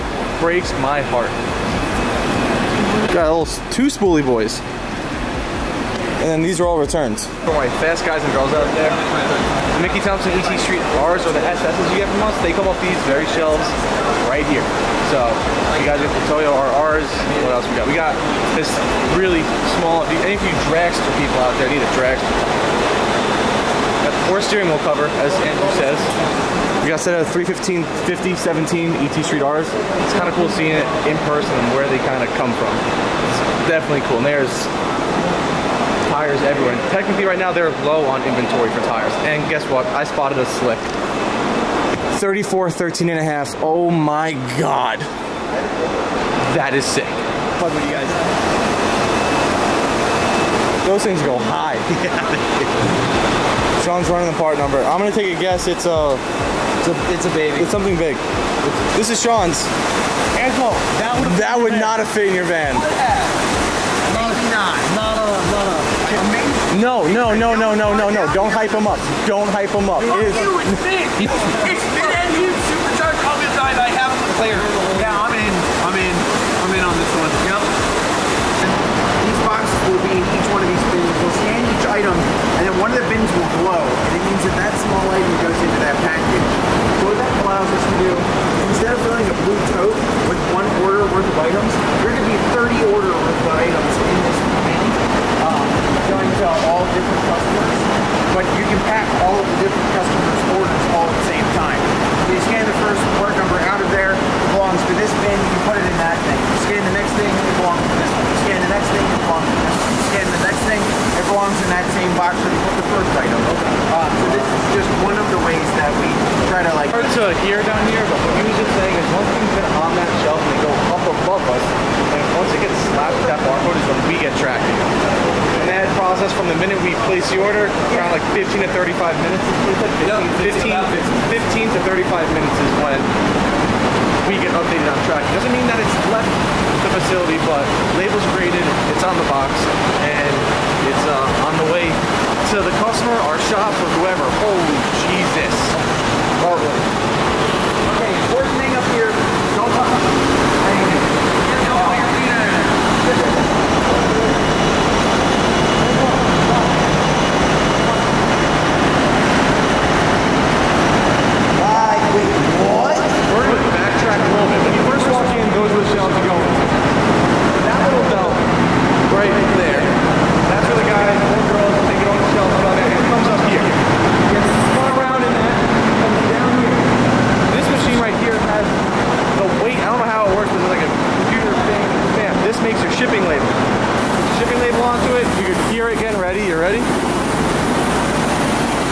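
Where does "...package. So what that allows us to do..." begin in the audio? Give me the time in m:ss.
1:26.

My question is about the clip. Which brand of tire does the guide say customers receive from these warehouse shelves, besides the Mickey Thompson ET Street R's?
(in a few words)
Toyo RRs.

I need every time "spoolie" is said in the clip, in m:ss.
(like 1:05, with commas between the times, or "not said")
0:03.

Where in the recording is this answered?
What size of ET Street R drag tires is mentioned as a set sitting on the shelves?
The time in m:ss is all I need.
0:27.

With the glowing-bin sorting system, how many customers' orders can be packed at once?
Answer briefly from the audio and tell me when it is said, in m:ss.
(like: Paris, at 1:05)
30, at 1:32.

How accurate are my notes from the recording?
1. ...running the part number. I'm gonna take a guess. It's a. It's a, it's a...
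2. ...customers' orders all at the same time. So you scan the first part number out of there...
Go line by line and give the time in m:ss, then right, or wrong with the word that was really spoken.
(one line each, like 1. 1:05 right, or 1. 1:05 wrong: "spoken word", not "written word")
1. 0:54 right
2. 1:39 right.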